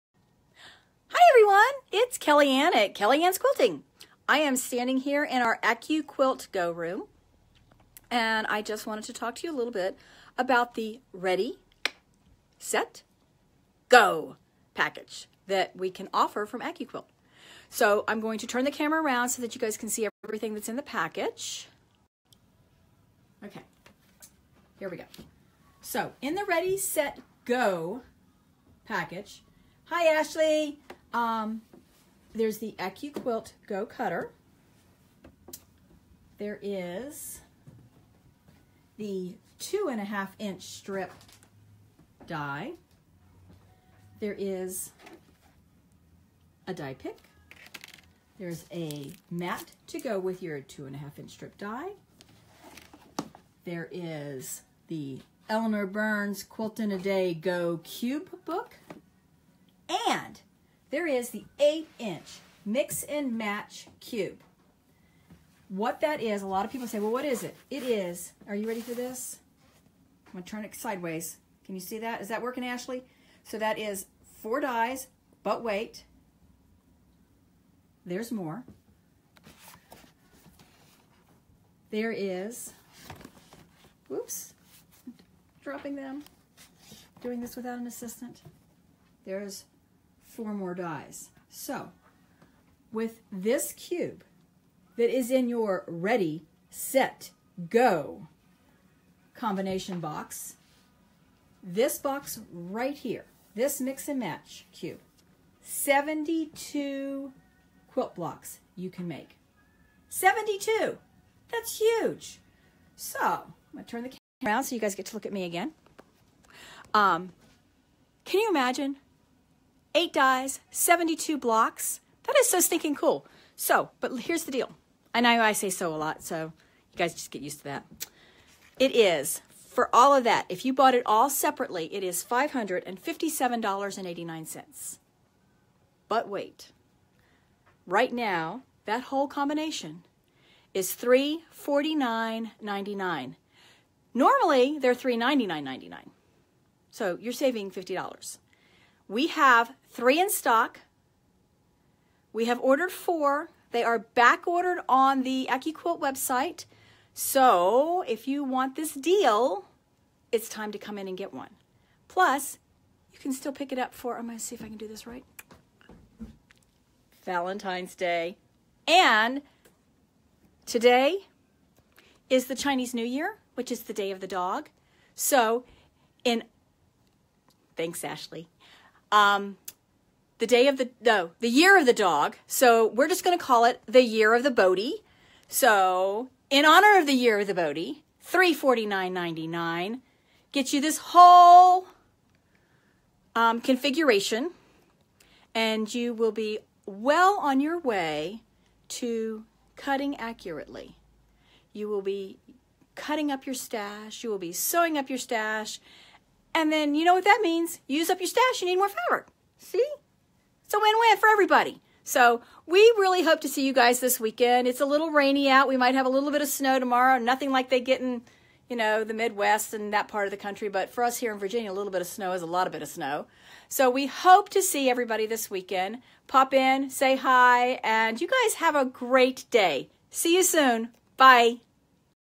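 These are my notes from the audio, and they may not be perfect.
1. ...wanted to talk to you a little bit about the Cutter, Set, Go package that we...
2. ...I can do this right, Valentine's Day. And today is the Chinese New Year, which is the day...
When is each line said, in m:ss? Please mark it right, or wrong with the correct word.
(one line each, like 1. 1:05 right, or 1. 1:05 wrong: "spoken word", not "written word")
1. 0:08 wrong: "Ready", not "Cutter"
2. 2:44 right.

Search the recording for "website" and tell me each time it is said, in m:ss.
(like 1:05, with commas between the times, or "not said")
2:35.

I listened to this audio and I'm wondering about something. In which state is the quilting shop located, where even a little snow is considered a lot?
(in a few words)
Virginia.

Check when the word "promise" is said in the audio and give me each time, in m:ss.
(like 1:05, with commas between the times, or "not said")
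not said.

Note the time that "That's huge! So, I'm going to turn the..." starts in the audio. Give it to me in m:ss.
1:51.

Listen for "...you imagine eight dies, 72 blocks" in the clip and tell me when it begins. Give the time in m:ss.
1:58.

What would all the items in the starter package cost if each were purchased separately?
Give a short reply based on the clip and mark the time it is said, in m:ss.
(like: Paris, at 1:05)
$557.89, at 2:12.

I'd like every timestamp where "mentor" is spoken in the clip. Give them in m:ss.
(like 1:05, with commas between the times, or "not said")
not said.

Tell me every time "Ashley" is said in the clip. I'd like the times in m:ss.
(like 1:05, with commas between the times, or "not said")
0:30, 1:12, 2:58.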